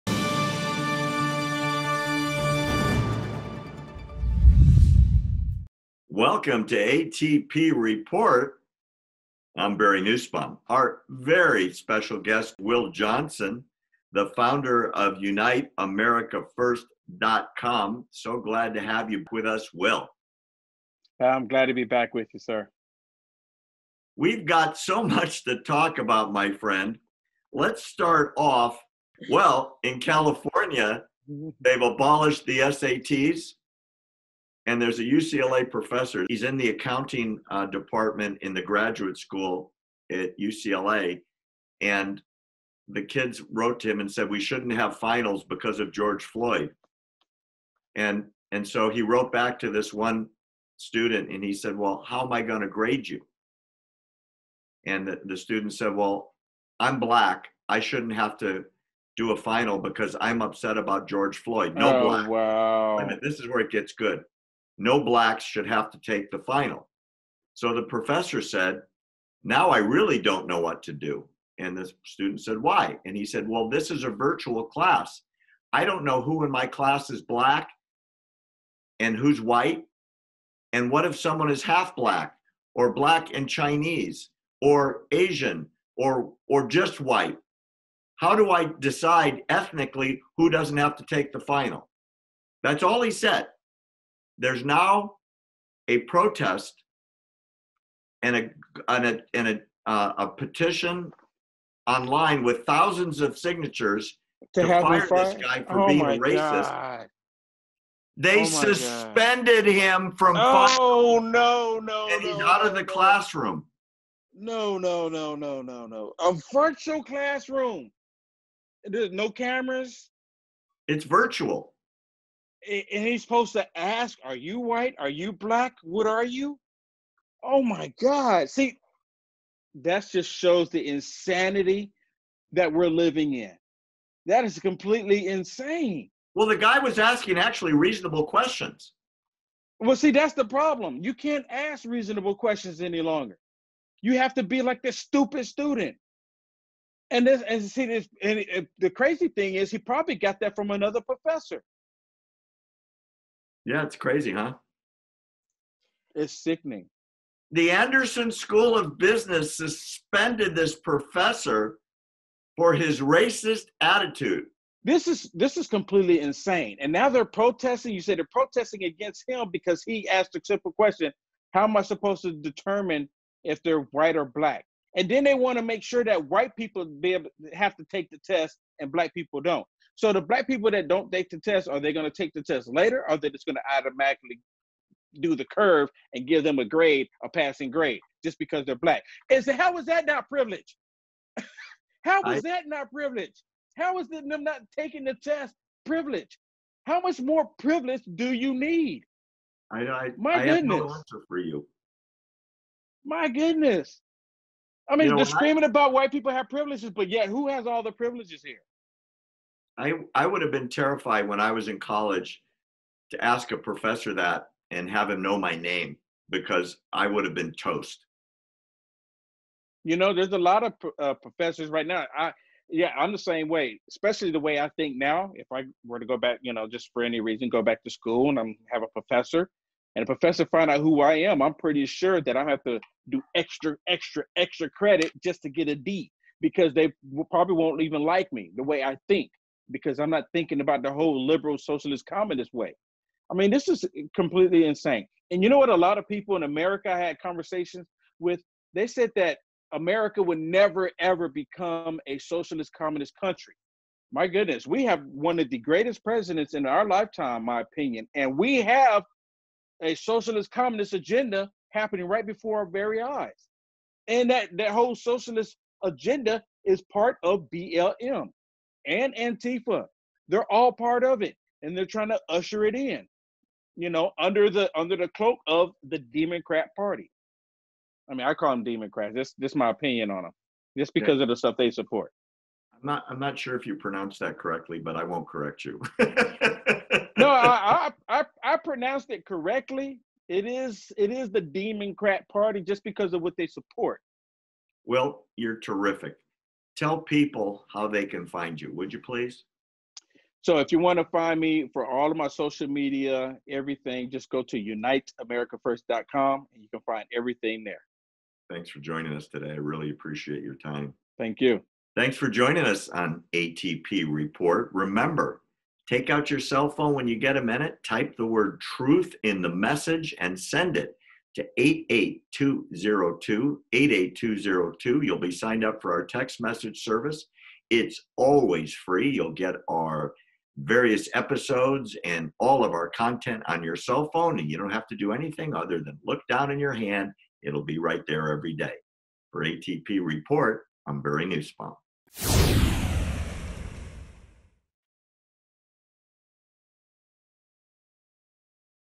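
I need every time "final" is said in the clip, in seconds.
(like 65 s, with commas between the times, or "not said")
44 s, 59 s, 66 s, 91 s.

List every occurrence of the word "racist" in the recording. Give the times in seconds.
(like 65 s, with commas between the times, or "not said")
106 s, 163 s.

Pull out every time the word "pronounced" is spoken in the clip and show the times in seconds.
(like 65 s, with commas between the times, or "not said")
283 s, 288 s.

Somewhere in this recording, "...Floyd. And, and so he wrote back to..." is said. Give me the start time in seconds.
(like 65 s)
46 s.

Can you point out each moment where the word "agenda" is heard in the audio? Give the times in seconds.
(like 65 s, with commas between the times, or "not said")
260 s, 265 s.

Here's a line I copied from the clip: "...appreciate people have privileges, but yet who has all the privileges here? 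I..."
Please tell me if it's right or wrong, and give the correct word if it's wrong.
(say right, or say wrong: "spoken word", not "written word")
wrong: "white", not "appreciate".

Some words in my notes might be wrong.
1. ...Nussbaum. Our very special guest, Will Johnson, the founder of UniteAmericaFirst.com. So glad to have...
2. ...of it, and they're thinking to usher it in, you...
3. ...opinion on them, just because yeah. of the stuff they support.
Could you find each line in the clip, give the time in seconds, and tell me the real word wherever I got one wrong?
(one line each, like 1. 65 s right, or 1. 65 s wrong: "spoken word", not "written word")
1. 10 s right
2. 271 s wrong: "trying", not "thinking"
3. 279 s right.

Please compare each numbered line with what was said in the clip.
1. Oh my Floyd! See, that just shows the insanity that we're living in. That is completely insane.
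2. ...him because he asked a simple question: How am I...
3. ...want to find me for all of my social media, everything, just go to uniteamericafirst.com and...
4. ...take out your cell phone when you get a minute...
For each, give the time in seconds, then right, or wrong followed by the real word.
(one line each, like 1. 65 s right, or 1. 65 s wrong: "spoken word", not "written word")
1. 127 s wrong: "God", not "Floyd"
2. 169 s right
3. 300 s right
4. 315 s right.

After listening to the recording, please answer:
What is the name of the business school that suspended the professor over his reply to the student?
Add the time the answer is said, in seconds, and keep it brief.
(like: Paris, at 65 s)
Anderson School of Business, at 157 s.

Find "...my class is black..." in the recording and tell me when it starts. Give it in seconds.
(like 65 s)
76 s.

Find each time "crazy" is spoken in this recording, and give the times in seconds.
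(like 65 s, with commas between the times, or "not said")
148 s, 153 s.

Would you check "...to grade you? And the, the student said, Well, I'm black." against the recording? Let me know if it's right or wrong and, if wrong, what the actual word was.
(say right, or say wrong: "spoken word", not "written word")
right.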